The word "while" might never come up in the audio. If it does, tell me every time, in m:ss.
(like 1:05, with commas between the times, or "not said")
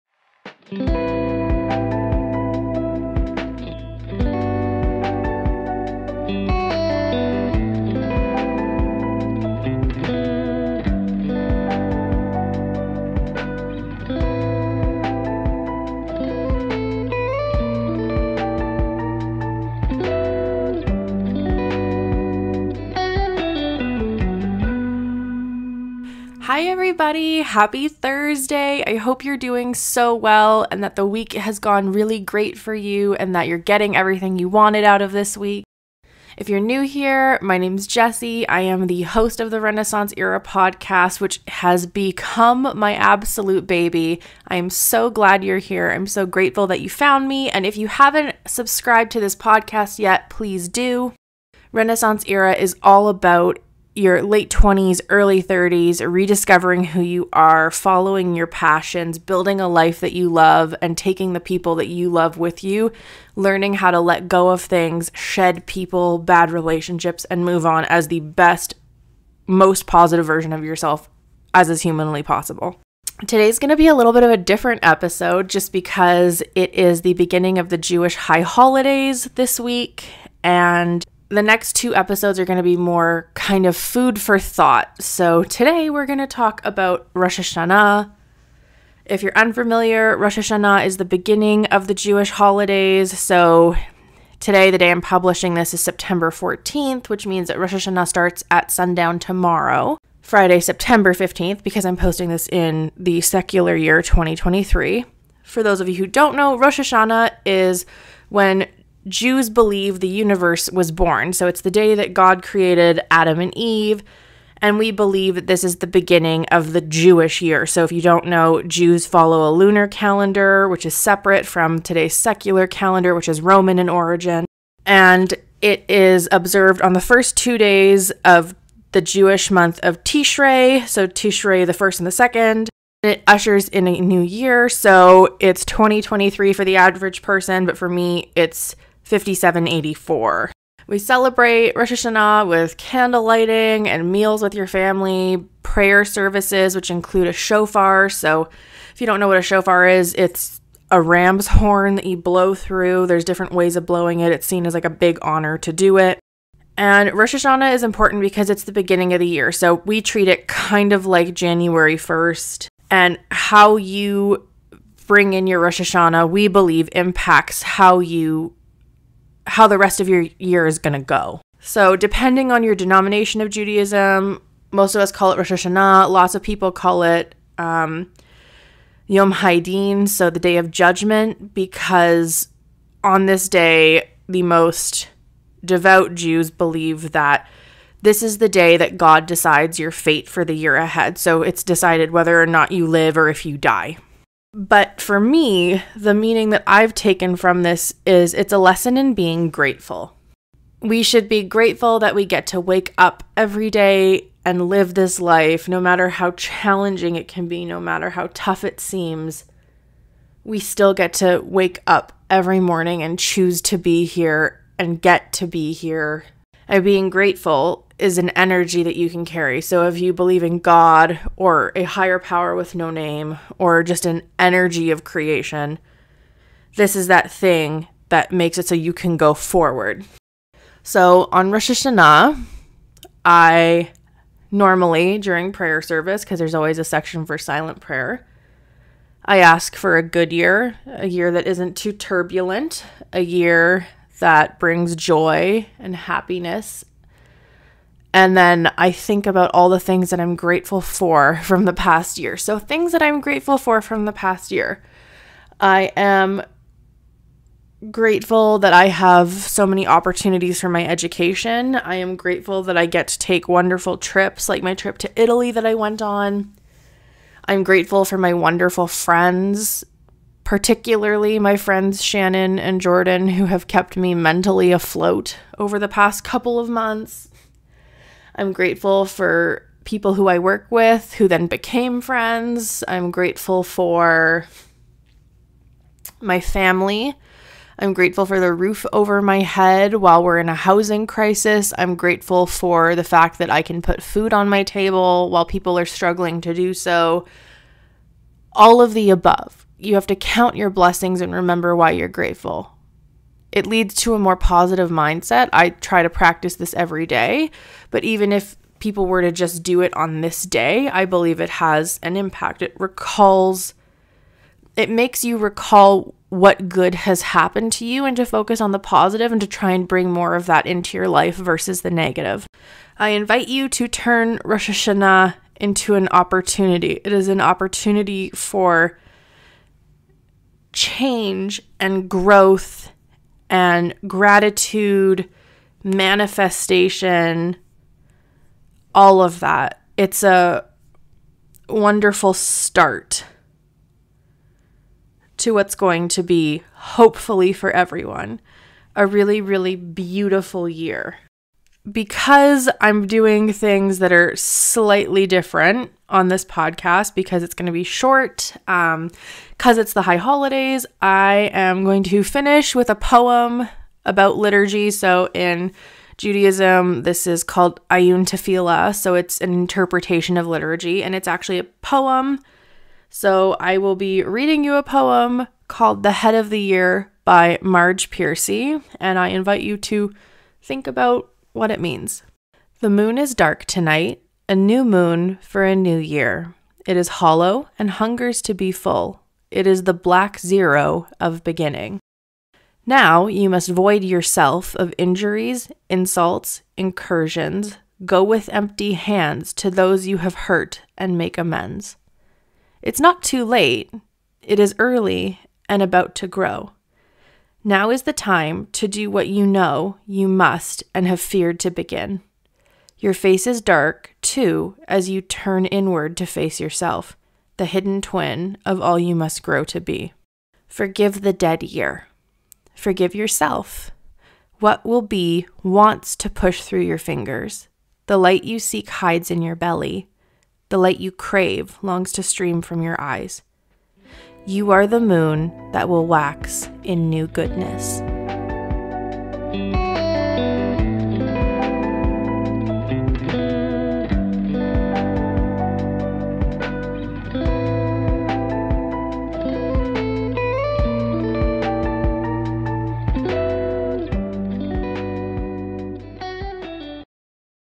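4:49, 4:55.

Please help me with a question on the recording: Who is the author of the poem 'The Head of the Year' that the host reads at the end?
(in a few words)
Marge Piercy.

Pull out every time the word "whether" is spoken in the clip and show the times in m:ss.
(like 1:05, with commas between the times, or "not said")
3:12.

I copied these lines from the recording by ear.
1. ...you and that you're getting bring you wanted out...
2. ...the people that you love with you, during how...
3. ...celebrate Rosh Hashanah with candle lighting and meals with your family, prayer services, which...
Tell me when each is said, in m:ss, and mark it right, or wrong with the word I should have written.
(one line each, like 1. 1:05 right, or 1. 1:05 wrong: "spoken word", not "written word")
1. 0:32 wrong: "everything", not "bring"
2. 1:01 wrong: "learning", not "during"
3. 2:20 right.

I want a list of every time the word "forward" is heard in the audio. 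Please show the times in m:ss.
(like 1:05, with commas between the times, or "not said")
3:49.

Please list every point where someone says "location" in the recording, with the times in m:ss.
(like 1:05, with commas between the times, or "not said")
not said.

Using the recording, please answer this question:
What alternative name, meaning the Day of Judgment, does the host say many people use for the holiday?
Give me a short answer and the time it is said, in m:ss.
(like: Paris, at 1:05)
Yom Haidin, at 2:59.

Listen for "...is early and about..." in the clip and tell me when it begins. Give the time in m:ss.
6:44.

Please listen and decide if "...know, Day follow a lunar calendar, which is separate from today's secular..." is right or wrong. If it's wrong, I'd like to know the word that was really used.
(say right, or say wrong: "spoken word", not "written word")
wrong: "Jews", not "Day".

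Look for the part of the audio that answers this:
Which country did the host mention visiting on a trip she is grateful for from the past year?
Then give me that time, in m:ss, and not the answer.
4:25.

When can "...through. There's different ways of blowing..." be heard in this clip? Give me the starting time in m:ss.
2:32.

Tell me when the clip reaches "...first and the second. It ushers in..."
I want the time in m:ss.
2:11.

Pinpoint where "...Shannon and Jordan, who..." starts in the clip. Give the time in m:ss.
4:32.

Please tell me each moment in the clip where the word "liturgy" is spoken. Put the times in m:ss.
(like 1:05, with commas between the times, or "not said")
6:04, 6:10.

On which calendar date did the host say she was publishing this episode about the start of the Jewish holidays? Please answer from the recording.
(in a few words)
September 14th.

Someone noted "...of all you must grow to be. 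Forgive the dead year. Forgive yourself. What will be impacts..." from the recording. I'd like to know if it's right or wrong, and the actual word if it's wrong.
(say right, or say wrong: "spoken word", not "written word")
wrong: "wants", not "impacts".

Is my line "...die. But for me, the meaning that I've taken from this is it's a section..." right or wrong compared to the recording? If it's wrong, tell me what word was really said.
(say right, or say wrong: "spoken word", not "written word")
wrong: "lesson", not "section".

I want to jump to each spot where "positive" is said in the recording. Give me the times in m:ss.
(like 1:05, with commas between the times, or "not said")
1:09, 5:04, 5:18.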